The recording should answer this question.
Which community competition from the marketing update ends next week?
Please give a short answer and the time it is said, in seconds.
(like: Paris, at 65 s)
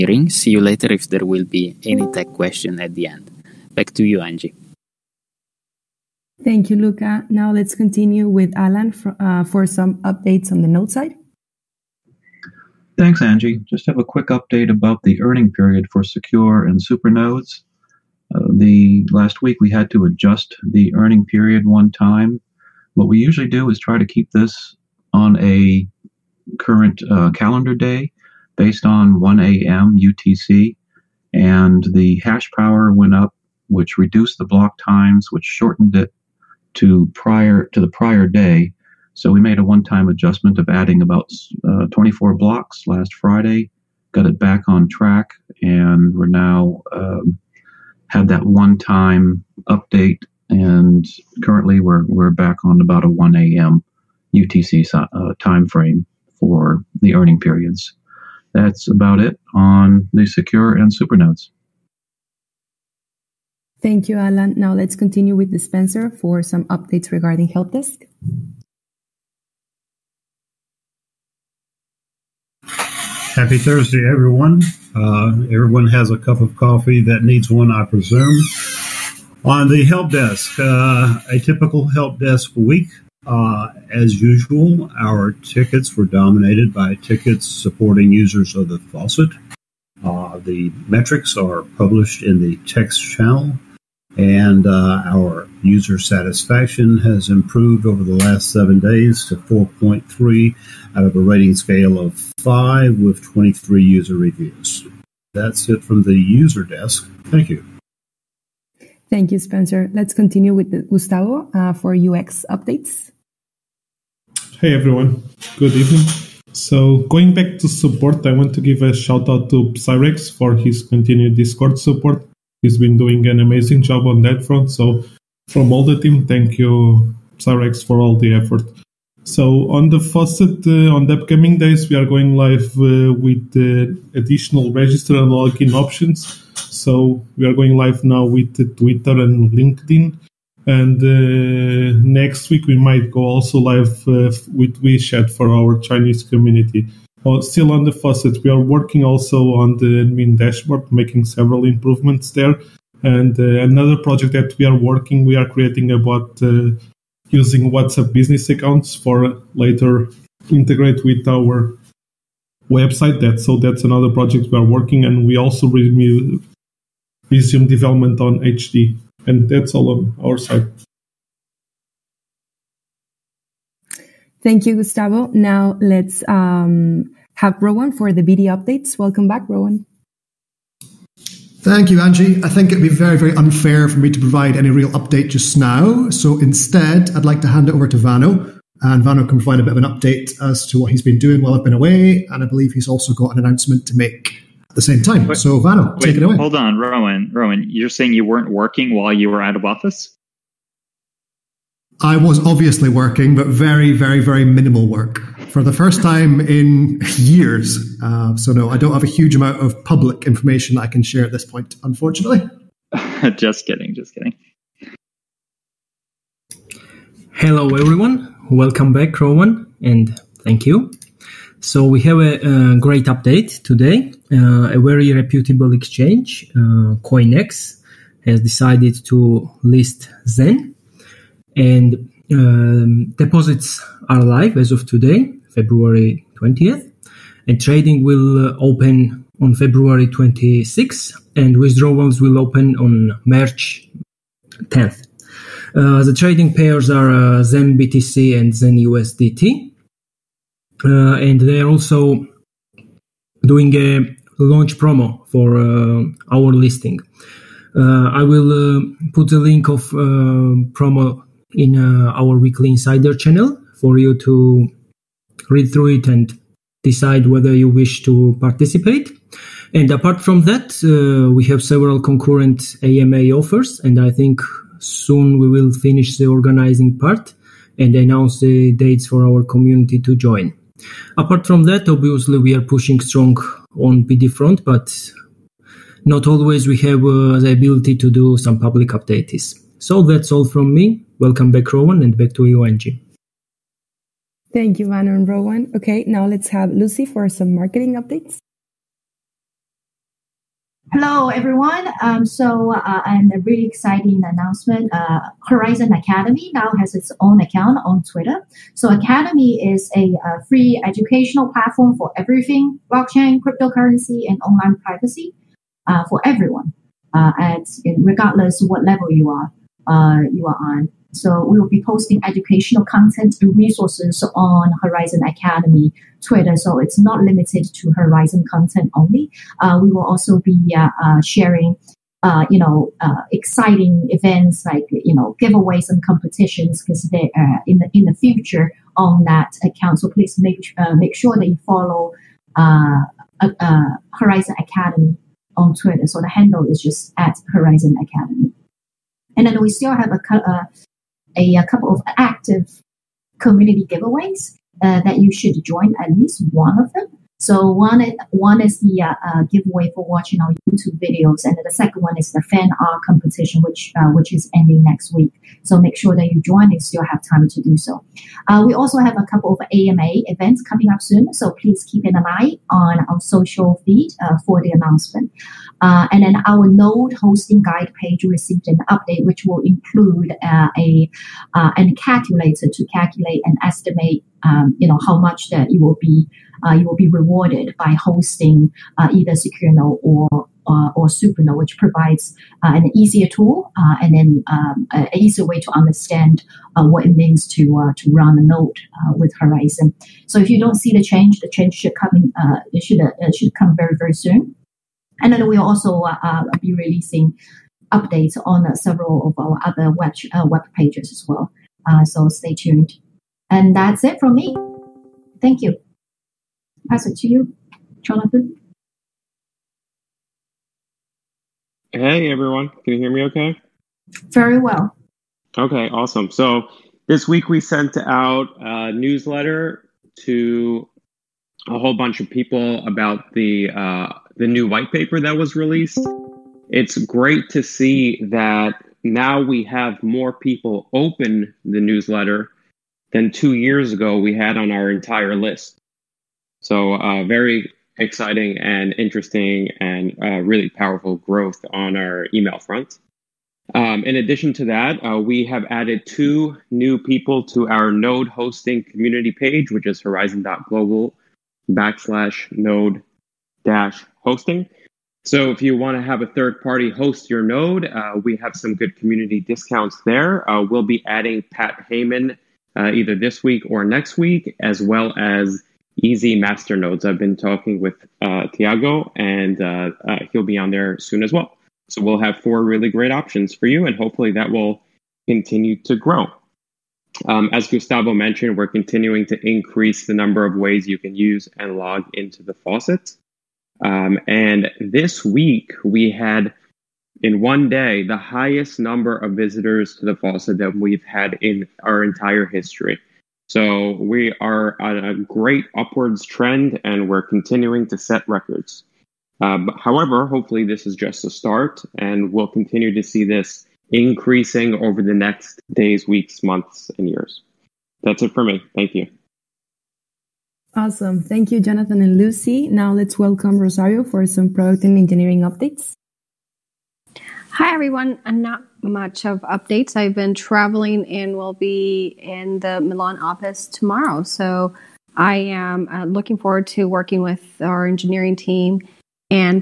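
fan art competition, at 362 s.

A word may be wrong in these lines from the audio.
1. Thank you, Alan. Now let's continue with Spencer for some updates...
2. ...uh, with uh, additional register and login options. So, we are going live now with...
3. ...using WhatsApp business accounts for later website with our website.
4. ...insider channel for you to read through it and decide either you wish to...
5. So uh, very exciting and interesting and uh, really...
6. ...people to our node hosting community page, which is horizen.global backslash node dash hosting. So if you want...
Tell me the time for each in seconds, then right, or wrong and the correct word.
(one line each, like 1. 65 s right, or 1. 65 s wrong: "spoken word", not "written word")
1. 63 s right
2. 132 s right
3. 157 s wrong: "integrate", not "website"
4. 262 s wrong: "whether", not "either"
5. 446 s right
6. 456 s right.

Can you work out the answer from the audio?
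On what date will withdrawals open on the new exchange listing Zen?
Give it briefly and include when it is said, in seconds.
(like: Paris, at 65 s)
March 10th, at 243 s.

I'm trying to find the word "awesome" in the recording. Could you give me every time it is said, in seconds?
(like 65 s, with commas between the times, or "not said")
425 s, 520 s.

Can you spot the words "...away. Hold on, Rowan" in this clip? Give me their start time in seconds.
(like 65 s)
196 s.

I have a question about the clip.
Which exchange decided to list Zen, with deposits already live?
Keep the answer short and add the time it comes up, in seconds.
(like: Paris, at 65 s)
CoinEx, at 227 s.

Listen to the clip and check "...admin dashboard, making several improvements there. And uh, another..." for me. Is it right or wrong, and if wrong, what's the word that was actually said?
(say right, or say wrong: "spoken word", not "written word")
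right.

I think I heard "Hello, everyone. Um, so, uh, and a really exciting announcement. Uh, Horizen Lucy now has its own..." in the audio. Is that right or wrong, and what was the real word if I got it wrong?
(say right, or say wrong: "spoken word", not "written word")
wrong: "Academy", not "Lucy".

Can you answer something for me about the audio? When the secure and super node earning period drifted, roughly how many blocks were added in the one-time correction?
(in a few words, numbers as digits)
24.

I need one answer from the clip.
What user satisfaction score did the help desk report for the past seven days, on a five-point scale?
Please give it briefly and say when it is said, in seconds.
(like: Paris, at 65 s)
4.3, at 99 s.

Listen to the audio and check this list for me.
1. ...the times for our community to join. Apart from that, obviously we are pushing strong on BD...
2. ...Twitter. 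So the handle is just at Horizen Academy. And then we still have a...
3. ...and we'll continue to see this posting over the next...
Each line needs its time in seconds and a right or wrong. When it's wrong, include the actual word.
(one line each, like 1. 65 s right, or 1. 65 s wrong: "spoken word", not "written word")
1. 278 s wrong: "dates", not "times"
2. 345 s right
3. 511 s wrong: "increasing", not "posting".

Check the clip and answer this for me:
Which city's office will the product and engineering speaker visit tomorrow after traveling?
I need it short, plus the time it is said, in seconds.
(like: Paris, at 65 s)
Milan, at 532 s.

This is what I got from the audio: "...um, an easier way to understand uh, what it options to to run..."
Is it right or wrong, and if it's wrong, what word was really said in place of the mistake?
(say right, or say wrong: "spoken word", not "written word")
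wrong: "means", not "options".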